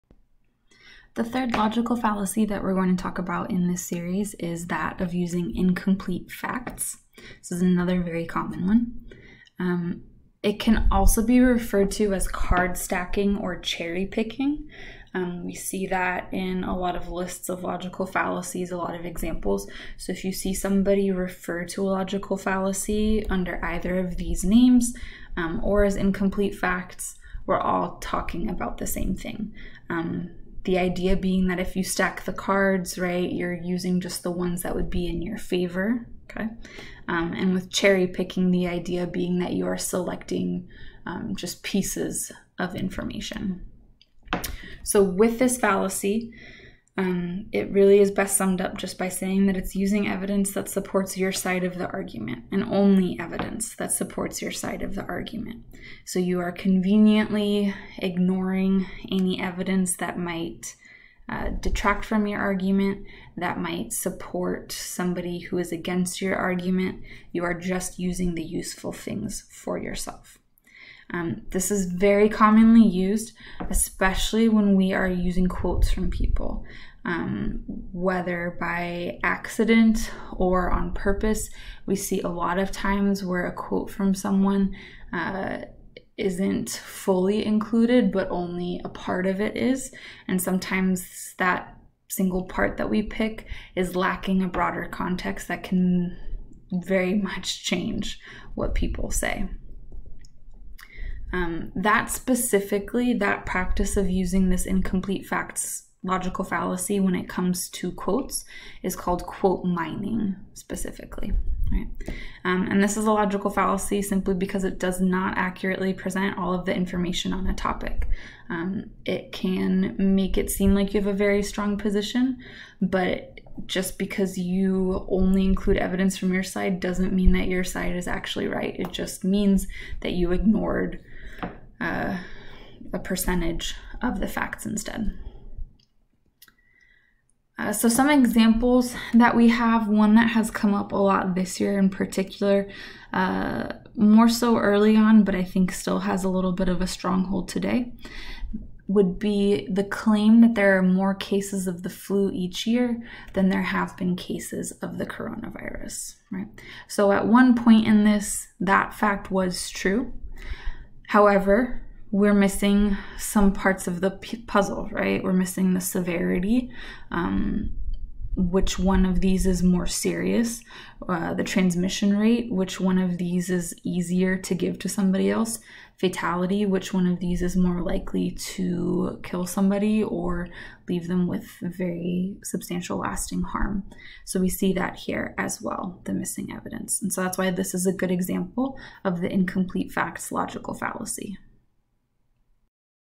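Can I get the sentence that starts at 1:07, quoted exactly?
You are just using the useful things for yourself.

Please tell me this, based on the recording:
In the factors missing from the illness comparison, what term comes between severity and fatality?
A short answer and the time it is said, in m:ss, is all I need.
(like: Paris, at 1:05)
Transmission rate, at 2:51.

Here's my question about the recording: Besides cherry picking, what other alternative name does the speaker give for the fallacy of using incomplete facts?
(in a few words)
Card stacking.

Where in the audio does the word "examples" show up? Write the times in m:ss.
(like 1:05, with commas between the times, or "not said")
0:19, 2:18, 3:08.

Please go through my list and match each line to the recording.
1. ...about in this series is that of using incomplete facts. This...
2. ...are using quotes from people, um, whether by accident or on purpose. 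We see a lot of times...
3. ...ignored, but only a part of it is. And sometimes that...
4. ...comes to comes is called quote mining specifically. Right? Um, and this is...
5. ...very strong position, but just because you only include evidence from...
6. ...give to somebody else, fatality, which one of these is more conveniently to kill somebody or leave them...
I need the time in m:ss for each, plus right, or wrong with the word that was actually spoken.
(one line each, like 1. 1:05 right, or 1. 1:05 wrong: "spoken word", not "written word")
1. 0:03 right
2. 1:14 right
3. 1:27 wrong: "included", not "ignored"
4. 1:47 wrong: "quotes", not "comes"
5. 2:01 right
6. 2:54 wrong: "likely", not "conveniently".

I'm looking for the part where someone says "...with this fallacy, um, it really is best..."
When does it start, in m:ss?
0:45.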